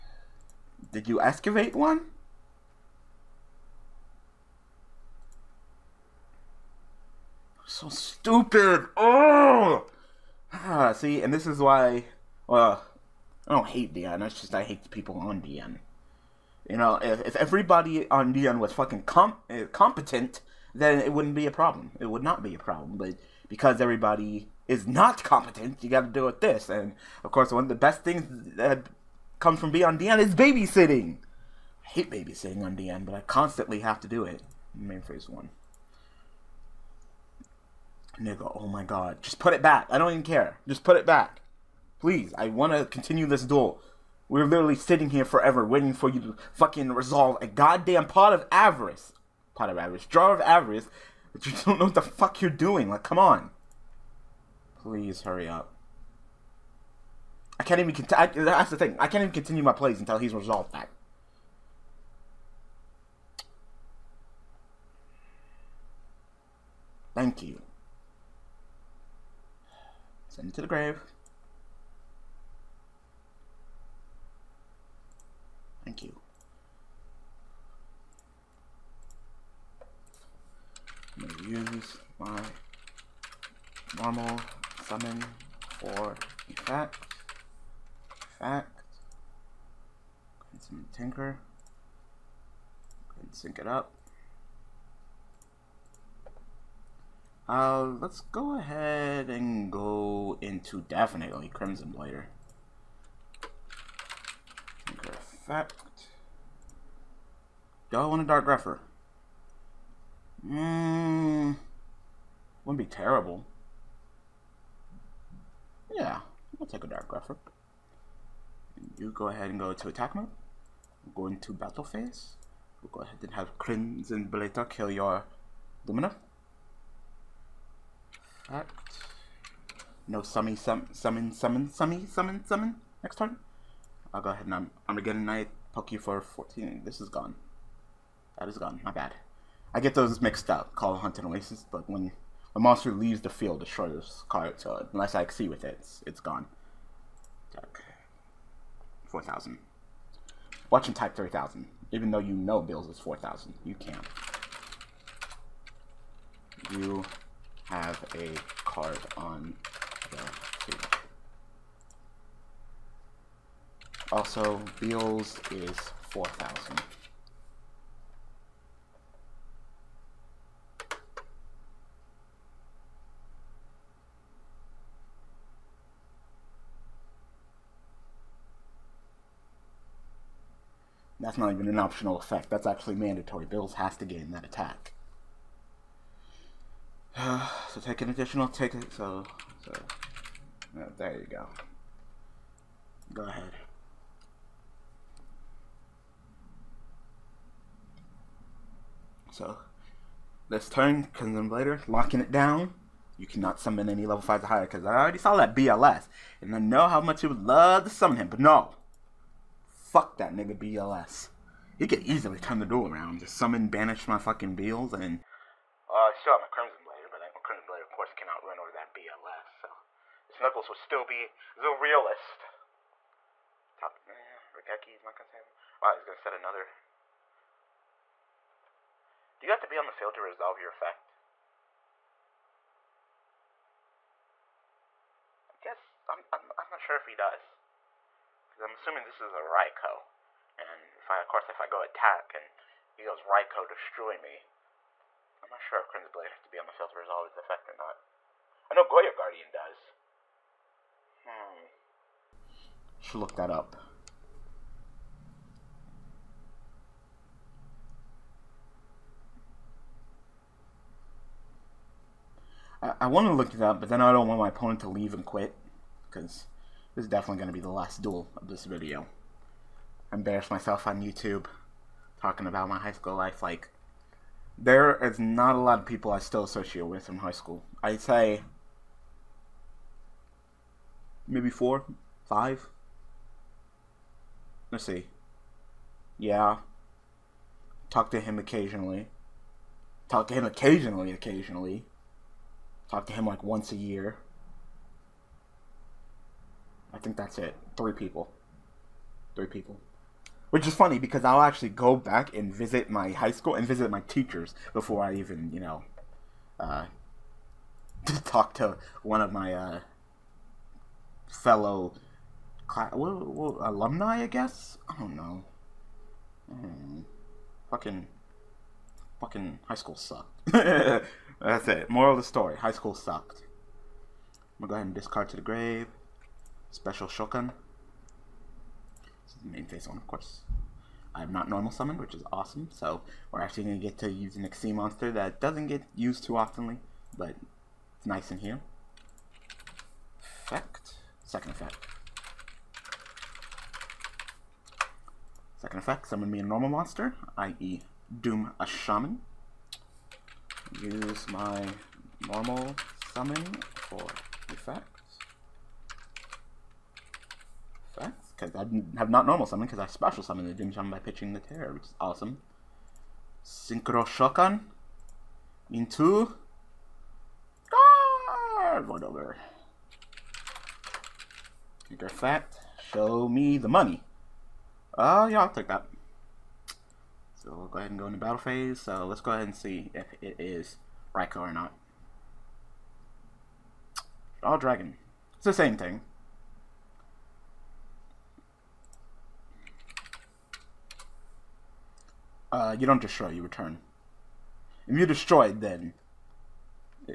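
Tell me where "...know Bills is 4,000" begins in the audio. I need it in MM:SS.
02:32.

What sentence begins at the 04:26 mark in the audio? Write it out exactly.
Because this is definitely going to be the last duel of this video.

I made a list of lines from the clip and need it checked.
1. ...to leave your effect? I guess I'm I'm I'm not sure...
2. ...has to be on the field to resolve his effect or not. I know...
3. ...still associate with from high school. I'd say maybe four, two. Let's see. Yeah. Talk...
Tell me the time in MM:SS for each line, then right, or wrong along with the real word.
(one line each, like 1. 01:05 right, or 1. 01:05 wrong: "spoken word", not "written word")
1. 03:50 wrong: "resolve", not "leave"
2. 04:06 right
3. 04:36 wrong: "five", not "two".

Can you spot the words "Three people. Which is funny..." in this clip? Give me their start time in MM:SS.
04:59.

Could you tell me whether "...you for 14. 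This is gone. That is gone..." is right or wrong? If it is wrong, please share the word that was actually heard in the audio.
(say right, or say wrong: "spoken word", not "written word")
right.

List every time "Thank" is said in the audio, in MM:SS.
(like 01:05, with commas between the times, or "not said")
01:07, 01:15.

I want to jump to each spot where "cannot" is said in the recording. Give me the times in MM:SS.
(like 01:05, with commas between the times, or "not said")
03:23, 03:38.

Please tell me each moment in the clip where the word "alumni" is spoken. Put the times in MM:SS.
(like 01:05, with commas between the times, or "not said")
05:13.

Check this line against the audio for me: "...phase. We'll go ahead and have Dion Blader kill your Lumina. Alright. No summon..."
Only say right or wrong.
wrong.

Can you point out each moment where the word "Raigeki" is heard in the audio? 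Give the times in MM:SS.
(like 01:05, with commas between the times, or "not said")
03:44.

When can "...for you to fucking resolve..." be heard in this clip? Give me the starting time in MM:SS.
00:45.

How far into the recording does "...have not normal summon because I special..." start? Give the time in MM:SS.
05:58.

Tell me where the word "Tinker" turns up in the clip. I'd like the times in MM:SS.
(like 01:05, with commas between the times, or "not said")
01:30, 01:44.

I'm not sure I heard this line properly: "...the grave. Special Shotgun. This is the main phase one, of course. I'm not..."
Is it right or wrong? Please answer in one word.
right.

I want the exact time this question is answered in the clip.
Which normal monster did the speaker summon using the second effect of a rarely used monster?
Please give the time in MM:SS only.
05:48.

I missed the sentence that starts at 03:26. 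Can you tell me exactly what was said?
And I know how much you would love to summon him, but no.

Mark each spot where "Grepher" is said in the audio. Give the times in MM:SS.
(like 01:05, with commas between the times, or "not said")
01:48, 01:57.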